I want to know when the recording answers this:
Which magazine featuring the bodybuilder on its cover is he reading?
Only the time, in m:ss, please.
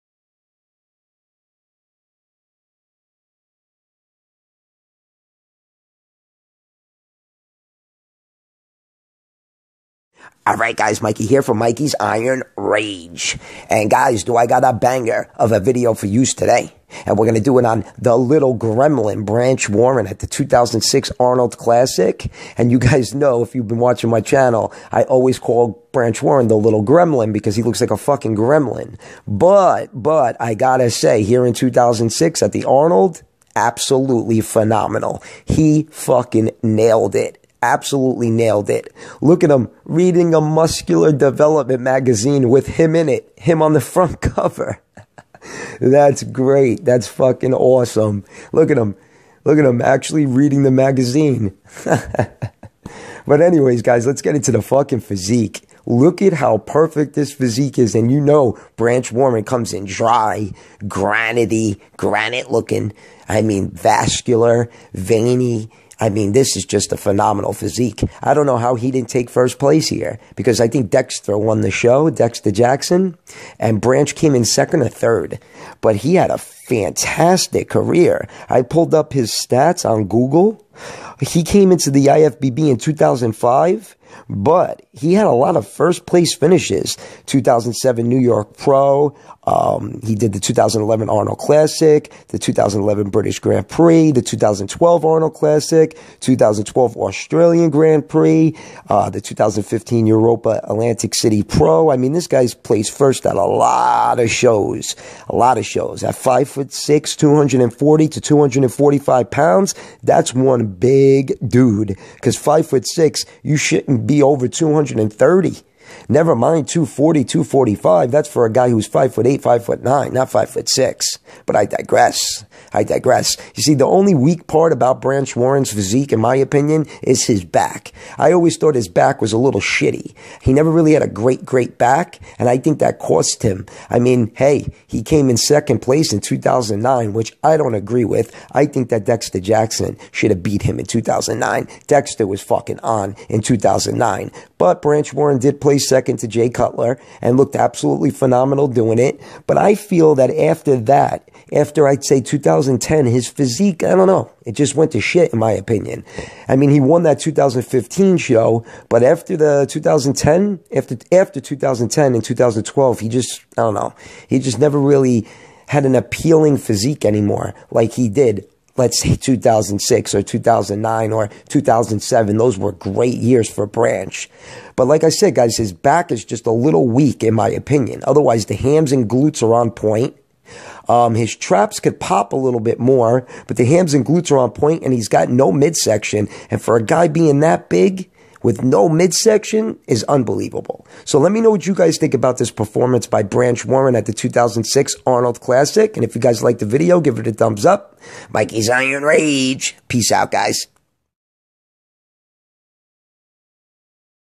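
0:40.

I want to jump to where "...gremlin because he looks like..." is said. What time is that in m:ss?
0:26.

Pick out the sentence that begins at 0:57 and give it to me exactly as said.
And you know, Branch Warren comes in dry, granity, granite looking.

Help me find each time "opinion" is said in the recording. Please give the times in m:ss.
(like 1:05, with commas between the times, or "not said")
2:06, 2:35, 2:57.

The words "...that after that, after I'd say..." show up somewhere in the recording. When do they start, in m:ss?
2:30.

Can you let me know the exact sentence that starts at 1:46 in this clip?
At five foot six, 240 to 245 pounds, that's one a big dude because five foot six, you shouldn't be over 230.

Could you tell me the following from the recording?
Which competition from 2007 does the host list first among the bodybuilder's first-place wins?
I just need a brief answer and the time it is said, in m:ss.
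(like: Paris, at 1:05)
New York Pro, at 1:28.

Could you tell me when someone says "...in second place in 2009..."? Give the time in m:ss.
2:15.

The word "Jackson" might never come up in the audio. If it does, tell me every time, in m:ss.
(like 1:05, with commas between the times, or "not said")
1:12, 2:19.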